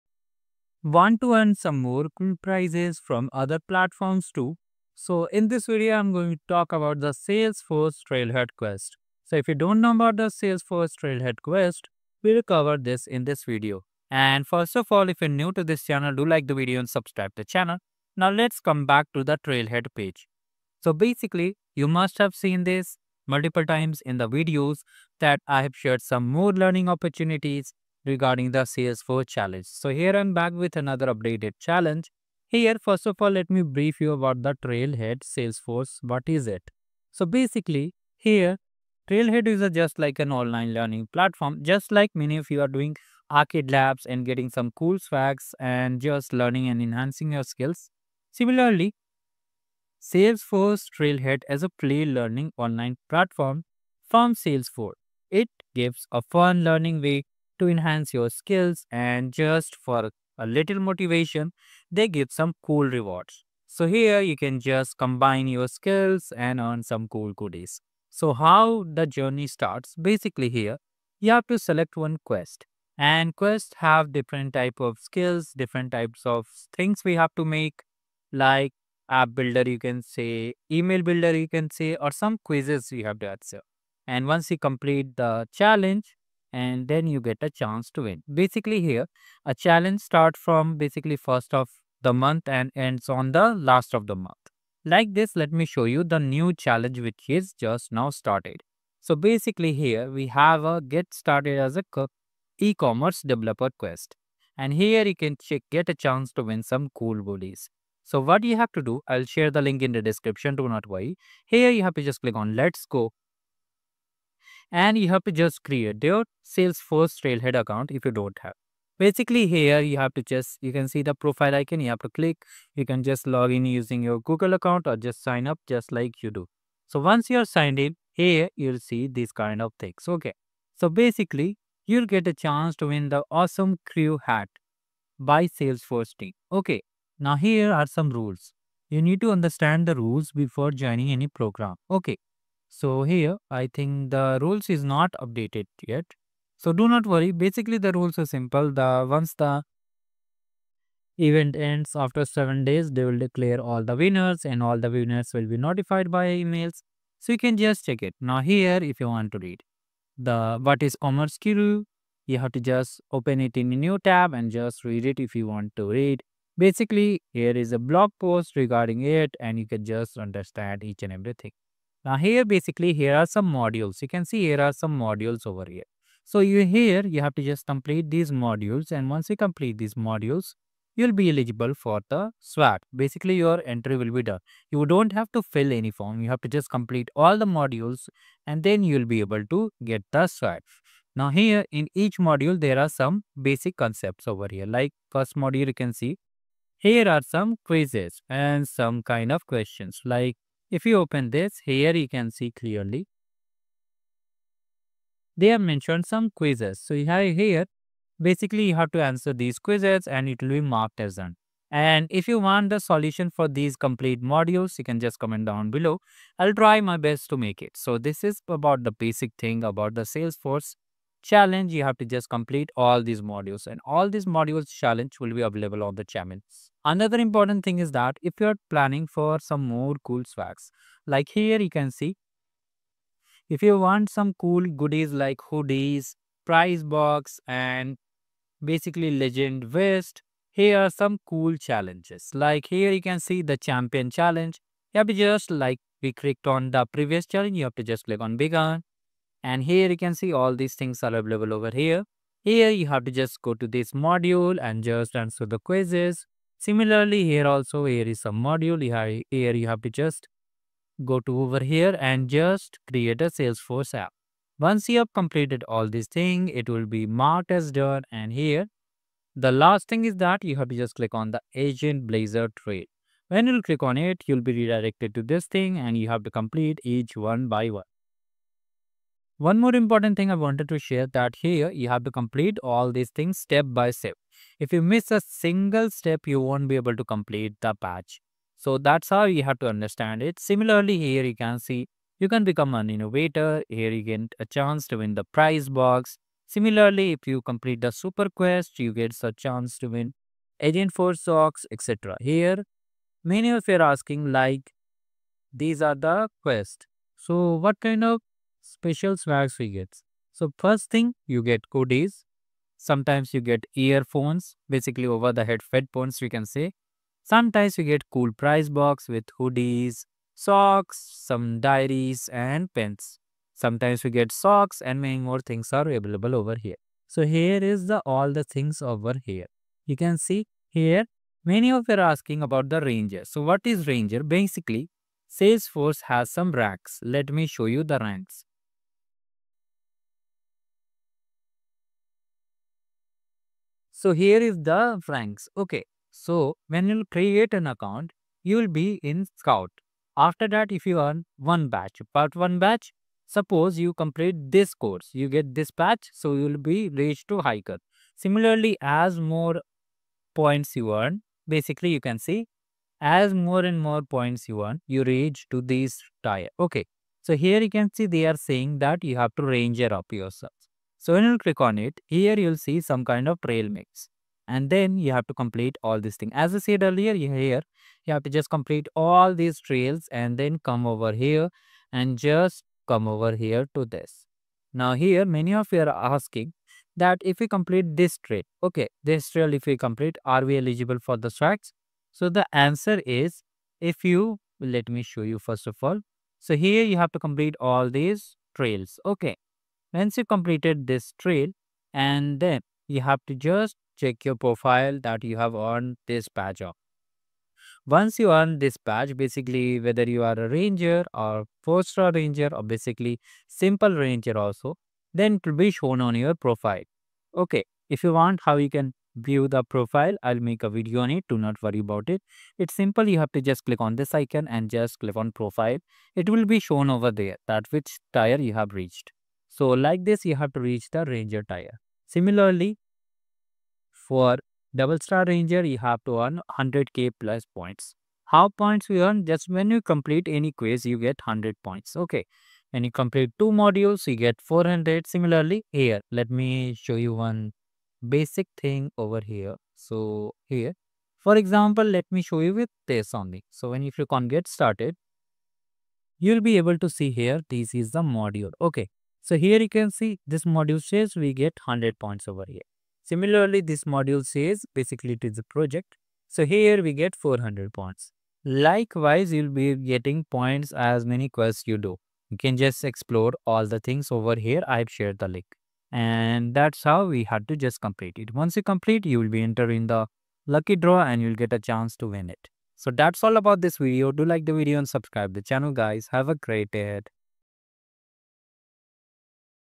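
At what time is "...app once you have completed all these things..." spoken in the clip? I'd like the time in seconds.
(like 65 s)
263 s.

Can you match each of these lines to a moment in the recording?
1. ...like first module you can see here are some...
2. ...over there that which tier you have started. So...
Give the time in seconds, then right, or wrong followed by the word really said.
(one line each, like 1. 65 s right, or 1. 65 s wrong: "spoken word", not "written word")
1. 194 s right
2. 426 s wrong: "reached", not "started".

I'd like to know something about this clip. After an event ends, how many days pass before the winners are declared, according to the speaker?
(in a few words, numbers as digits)
7 days.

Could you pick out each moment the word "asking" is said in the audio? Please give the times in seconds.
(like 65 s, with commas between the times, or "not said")
303 s, 331 s, 385 s.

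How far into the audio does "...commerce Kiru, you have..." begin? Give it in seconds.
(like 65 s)
161 s.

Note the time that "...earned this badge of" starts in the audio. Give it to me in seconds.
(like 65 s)
405 s.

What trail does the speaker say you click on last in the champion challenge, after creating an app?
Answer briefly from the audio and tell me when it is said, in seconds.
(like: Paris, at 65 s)
Agentblazer, at 271 s.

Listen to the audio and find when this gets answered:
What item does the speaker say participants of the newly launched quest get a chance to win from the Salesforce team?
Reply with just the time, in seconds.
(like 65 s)
133 s.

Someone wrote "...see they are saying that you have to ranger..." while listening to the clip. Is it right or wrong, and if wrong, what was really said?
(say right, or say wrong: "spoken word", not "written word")
right.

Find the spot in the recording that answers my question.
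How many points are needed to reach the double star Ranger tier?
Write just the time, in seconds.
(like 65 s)
436 s.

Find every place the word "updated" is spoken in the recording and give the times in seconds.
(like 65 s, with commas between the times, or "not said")
31 s, 145 s.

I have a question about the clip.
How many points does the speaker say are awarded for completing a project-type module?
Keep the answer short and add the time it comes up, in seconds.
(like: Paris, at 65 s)
400, at 467 s.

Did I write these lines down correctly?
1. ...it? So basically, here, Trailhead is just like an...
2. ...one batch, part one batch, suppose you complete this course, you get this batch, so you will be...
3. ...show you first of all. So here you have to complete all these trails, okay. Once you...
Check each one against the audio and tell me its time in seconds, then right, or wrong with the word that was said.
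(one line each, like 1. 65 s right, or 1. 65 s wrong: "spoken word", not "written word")
1. 36 s right
2. 351 s right
3. 395 s right.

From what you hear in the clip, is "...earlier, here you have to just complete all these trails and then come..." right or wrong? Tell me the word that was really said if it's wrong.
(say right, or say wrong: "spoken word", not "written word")
right.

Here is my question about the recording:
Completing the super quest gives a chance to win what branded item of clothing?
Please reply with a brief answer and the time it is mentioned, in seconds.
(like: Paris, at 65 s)
Agentforce socks, at 300 s.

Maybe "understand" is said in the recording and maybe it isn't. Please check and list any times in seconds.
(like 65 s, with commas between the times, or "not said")
139 s, 170 s, 289 s.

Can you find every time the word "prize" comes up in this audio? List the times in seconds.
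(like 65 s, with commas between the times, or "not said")
2 s, 236 s, 295 s, 318 s.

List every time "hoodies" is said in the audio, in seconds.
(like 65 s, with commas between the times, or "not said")
235 s, 319 s.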